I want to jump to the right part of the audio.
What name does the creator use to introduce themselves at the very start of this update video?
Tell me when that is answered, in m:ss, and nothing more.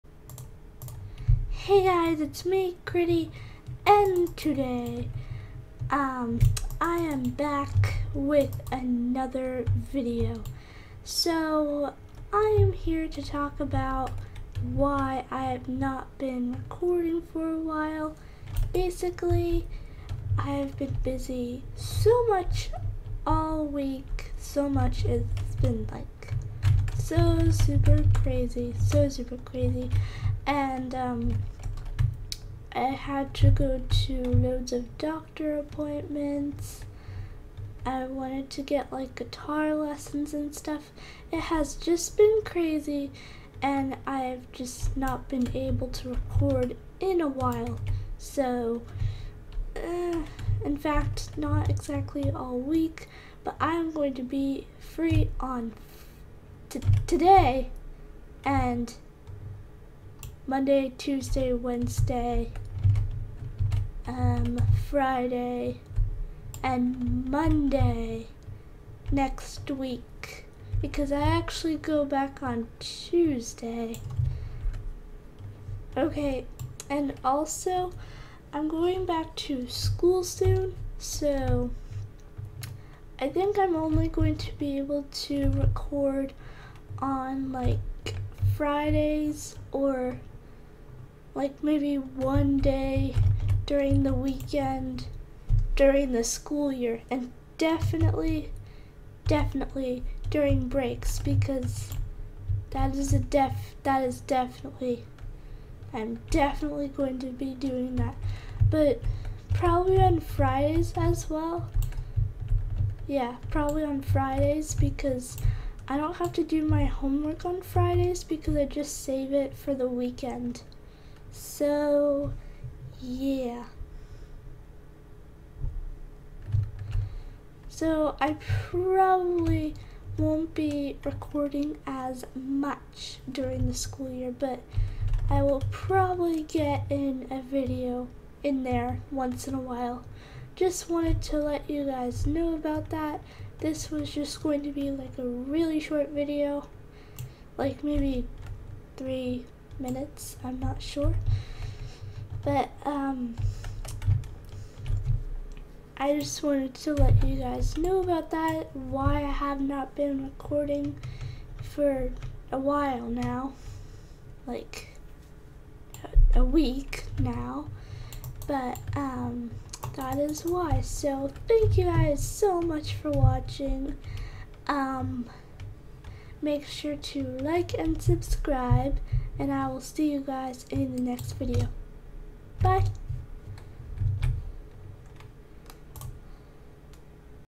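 0:02.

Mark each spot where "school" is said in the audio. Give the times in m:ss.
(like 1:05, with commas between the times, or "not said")
1:19, 1:36, 2:13.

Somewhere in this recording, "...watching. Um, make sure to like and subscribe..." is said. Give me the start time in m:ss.
2:53.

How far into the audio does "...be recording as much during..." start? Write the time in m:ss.
2:10.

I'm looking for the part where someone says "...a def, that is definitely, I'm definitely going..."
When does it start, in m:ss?
1:43.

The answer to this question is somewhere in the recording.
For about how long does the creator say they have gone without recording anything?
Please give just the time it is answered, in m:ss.
2:46.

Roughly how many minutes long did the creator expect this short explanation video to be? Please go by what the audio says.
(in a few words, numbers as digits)
3.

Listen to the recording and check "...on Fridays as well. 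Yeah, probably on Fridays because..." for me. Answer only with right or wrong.
right.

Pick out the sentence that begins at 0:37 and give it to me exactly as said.
I wanted to get like guitar lessons and stuff.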